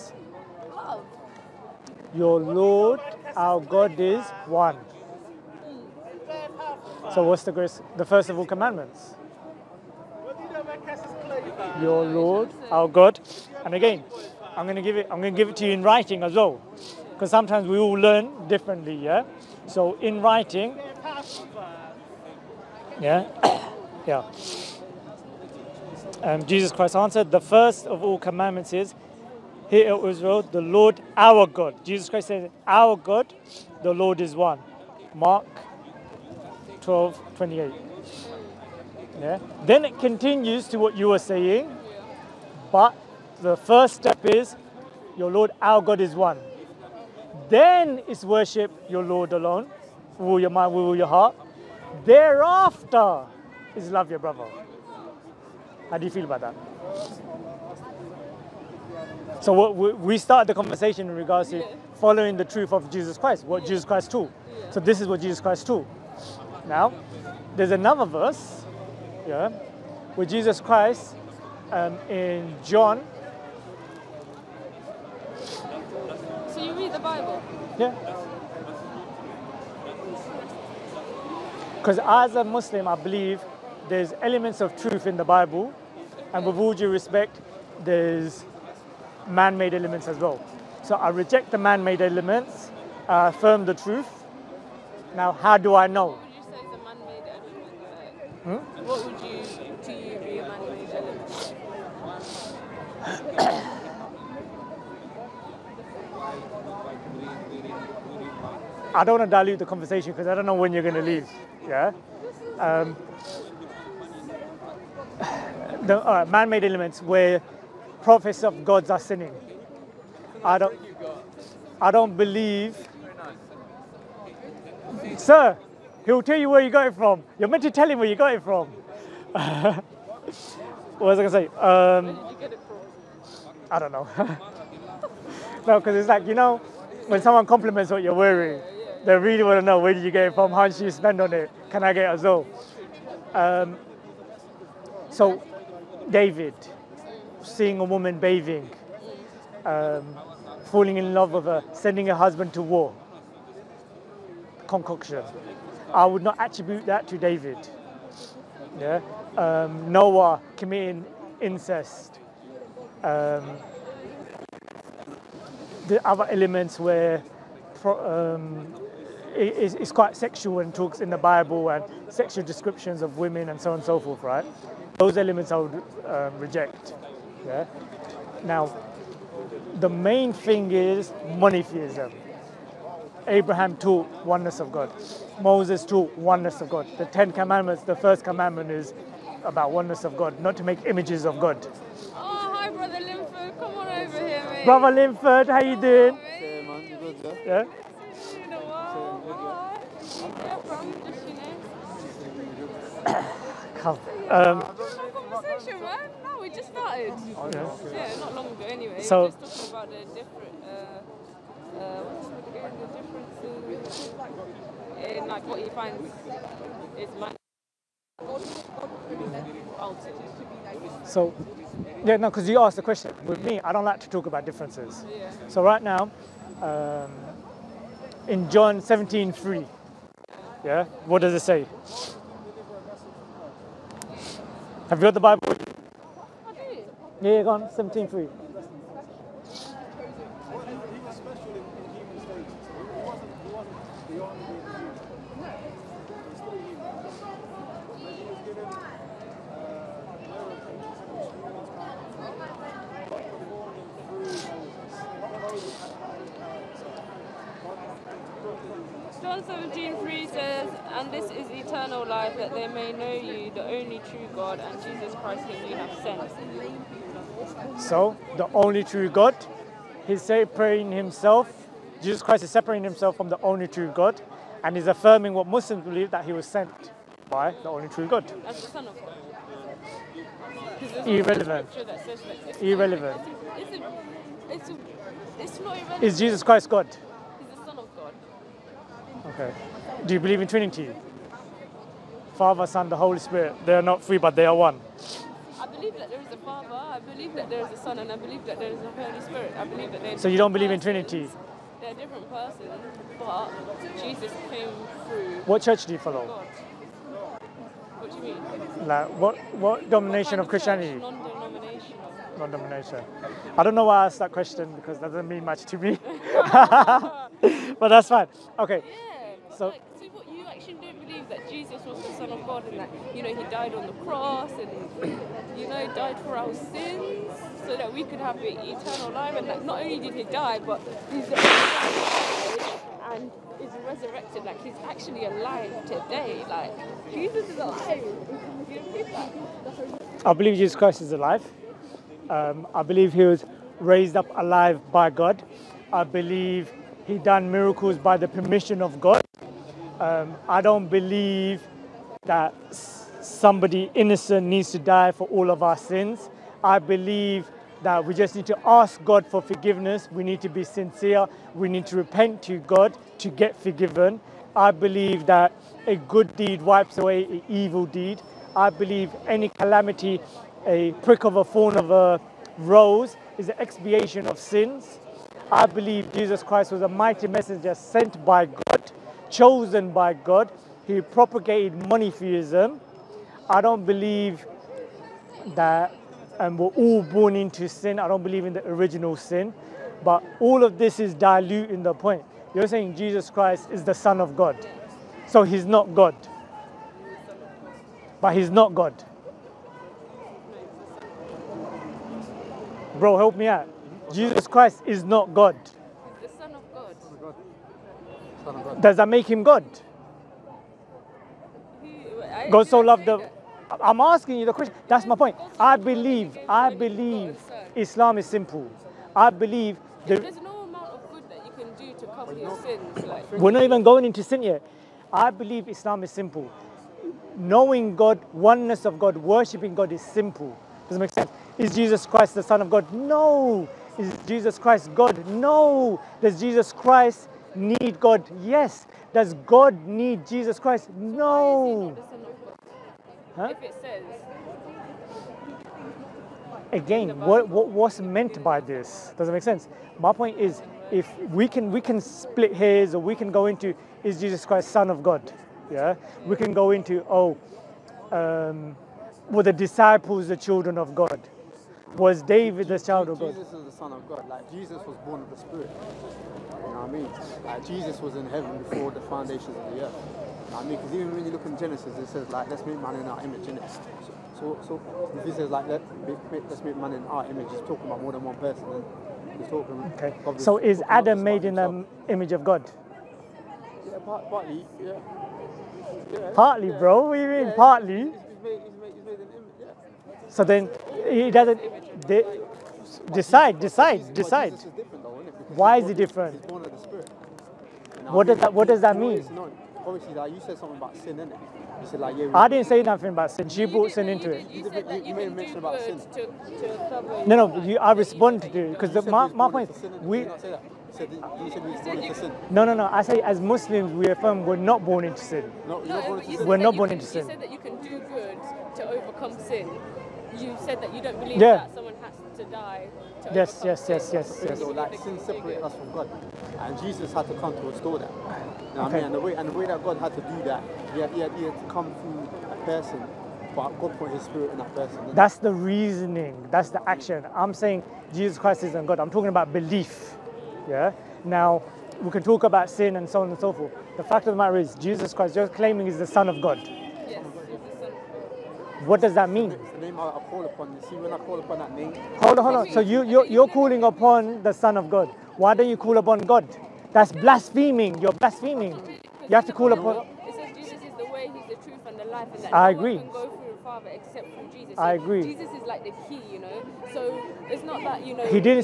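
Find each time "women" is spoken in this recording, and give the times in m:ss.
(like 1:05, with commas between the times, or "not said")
2:53.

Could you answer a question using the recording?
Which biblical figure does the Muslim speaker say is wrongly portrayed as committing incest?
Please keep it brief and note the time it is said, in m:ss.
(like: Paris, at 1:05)
Noah, at 2:39.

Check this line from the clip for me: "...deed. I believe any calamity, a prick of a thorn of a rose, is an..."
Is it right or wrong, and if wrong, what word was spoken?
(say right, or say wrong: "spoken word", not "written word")
right.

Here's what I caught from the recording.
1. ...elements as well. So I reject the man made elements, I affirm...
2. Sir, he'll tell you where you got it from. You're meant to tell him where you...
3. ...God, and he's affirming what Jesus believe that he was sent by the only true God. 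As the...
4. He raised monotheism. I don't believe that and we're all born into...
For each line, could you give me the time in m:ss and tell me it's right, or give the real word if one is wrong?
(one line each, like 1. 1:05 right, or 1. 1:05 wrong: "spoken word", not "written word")
1. 1:29 right
2. 2:05 right
3. 4:33 wrong: "Muslims", not "Jesus"
4. 6:20 wrong: "propagated", not "raised".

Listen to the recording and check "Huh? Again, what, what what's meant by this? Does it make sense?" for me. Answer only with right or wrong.
right.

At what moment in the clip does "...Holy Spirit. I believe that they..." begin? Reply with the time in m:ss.
4:59.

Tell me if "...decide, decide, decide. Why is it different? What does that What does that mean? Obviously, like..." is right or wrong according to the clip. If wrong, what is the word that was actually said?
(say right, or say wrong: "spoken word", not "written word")
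right.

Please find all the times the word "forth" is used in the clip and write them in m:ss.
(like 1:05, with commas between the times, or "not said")
2:53, 9:03.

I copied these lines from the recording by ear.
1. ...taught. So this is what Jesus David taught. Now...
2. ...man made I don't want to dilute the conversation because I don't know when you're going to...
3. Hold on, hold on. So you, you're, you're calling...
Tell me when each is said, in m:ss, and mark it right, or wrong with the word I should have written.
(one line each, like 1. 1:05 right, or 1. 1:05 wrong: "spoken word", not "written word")
1. 1:04 wrong: "Christ", not "David"
2. 1:39 right
3. 9:12 right.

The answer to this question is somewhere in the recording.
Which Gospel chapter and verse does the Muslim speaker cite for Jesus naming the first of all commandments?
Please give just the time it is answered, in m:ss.
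0:35.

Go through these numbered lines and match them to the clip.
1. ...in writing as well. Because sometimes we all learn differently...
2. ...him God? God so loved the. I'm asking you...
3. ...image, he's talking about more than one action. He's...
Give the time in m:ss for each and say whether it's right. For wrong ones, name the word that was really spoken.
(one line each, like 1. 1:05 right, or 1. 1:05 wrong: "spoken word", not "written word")
1. 0:15 right
2. 6:49 right
3. 7:57 wrong: "person", not "action".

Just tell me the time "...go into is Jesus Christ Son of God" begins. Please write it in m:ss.
7:33.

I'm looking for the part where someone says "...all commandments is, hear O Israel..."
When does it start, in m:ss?
0:28.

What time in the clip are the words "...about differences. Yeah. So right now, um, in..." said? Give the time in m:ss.
3:44.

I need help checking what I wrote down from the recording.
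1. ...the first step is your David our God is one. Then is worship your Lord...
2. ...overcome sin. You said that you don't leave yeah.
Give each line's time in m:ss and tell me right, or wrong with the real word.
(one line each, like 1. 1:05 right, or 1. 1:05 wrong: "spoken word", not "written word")
1. 0:43 wrong: "Lord", not "David"
2. 8:38 wrong: "believe", not "leave".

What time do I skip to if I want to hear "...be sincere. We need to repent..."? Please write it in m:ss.
6:00.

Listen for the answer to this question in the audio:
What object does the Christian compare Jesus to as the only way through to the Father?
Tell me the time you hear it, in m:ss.
9:25.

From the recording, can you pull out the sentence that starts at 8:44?
So like sin separates us from God, and Jesus had to come to restore that.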